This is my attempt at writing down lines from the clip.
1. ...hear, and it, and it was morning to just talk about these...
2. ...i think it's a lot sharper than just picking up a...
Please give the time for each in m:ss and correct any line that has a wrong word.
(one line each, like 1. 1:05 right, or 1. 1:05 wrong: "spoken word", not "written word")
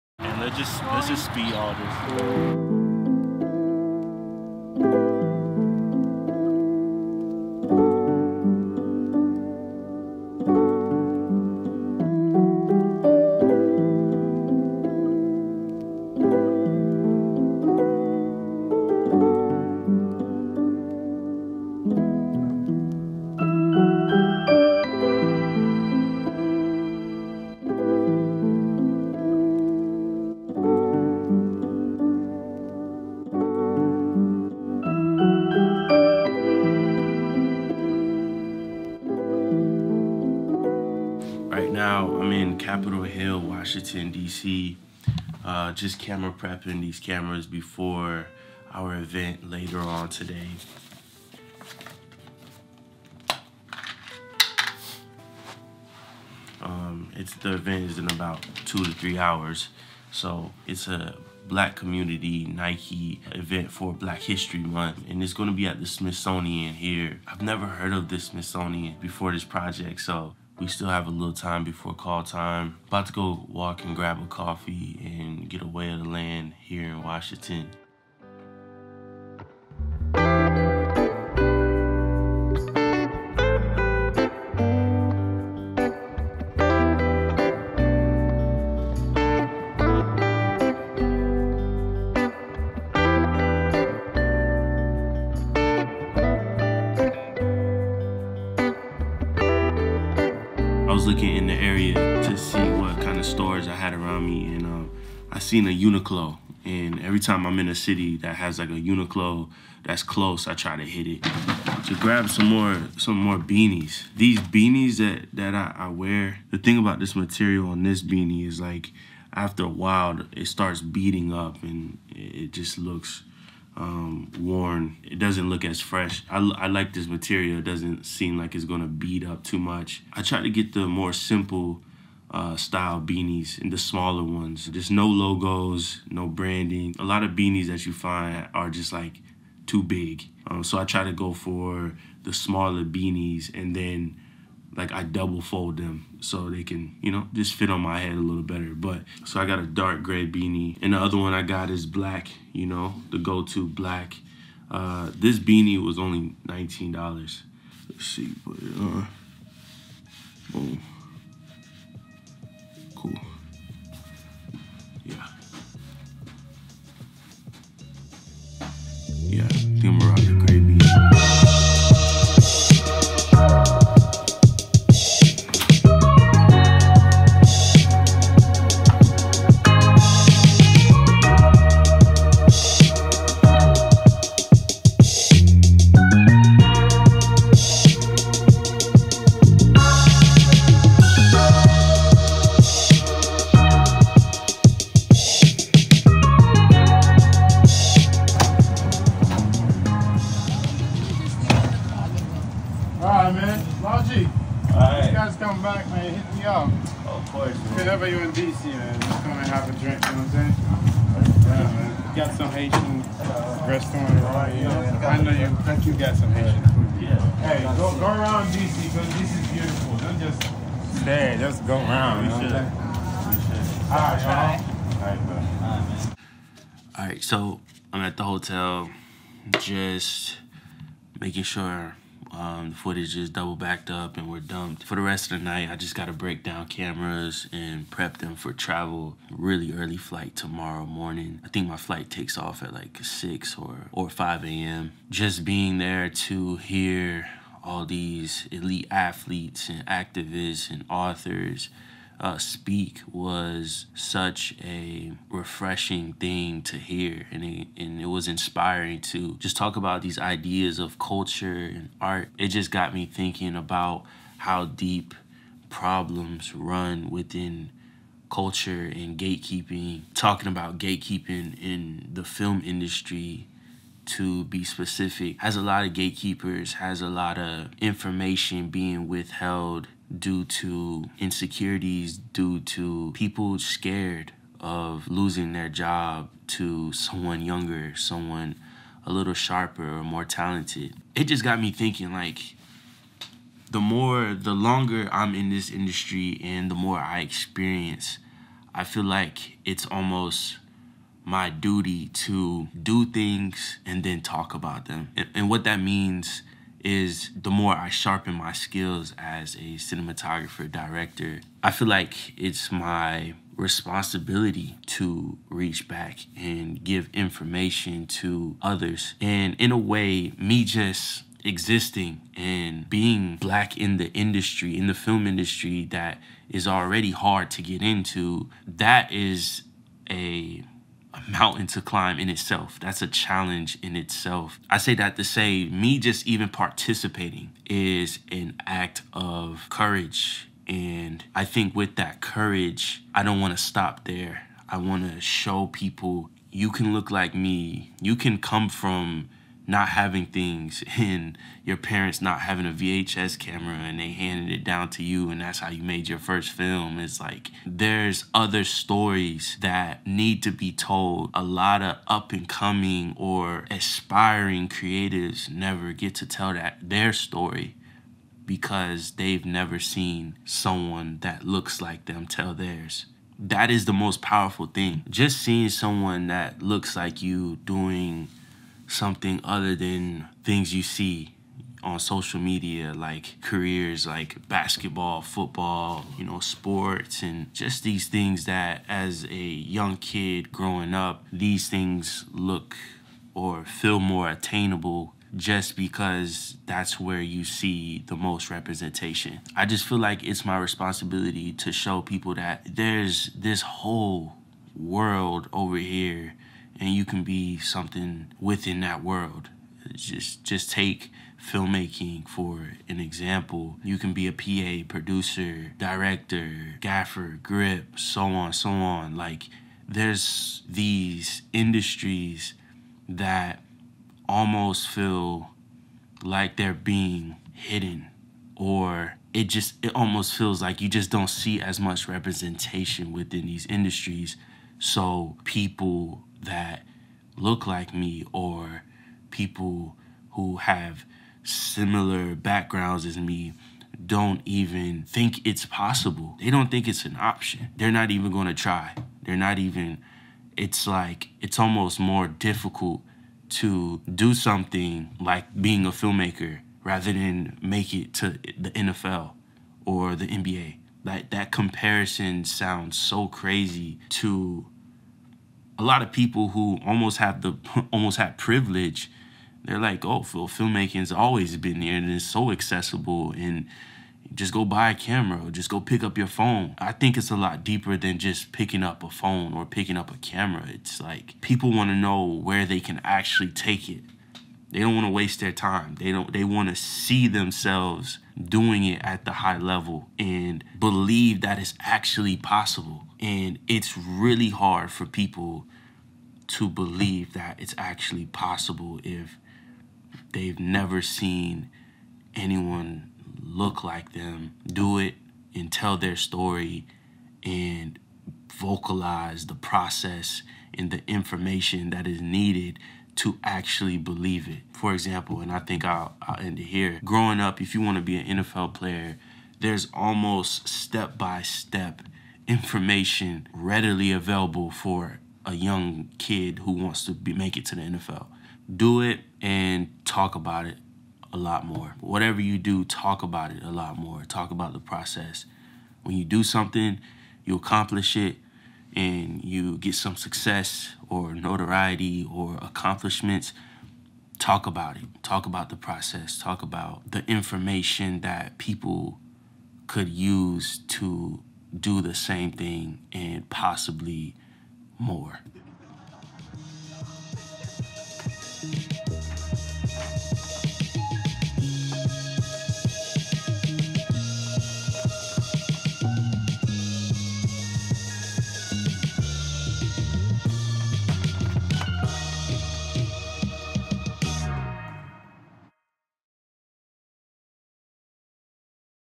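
1. 4:16 wrong: "inspiring", not "morning"
2. 7:56 wrong: "deeper", not "sharper".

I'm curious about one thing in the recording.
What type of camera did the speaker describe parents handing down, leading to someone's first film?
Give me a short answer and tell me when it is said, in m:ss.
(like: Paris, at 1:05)
VHS camera, at 5:52.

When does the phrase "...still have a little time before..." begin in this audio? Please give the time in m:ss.
1:10.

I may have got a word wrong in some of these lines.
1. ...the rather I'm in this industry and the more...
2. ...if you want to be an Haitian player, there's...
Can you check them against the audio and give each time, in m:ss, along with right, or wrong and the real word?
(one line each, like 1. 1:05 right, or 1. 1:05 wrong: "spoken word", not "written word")
1. 4:54 wrong: "longer", not "rather"
2. 8:37 wrong: "NFL", not "Haitian".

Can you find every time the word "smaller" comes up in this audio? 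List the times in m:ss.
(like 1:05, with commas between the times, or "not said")
2:13, 2:22.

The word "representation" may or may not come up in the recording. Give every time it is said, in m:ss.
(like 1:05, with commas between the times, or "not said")
6:38, 7:12.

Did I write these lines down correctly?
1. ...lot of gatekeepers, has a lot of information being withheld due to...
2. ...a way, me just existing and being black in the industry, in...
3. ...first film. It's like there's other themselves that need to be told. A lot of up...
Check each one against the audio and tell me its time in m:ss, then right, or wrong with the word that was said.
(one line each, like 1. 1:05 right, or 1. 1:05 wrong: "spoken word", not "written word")
1. 4:35 right
2. 5:19 right
3. 5:56 wrong: "stories", not "themselves".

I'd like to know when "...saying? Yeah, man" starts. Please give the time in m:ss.
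3:31.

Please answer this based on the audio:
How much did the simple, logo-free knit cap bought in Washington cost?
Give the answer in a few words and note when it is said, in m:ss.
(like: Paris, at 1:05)
$19, at 2:36.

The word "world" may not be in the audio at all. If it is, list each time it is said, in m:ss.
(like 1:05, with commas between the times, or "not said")
6:44, 6:49.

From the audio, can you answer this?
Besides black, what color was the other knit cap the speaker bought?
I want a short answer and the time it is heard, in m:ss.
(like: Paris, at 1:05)
dark gray, at 2:29.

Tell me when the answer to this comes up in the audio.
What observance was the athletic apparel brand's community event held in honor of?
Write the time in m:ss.
1:03.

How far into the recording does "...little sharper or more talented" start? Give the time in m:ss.
4:49.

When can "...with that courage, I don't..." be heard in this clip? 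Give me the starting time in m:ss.
5:41.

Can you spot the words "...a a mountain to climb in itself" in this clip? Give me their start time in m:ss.
5:30.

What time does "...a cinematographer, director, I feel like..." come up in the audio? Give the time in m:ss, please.
5:09.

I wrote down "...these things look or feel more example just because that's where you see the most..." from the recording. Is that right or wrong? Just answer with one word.
wrong.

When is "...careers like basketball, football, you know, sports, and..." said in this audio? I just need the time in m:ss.
6:23.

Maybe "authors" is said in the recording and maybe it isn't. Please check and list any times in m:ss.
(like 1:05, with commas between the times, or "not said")
4:10.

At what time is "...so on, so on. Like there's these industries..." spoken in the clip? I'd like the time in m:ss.
6:57.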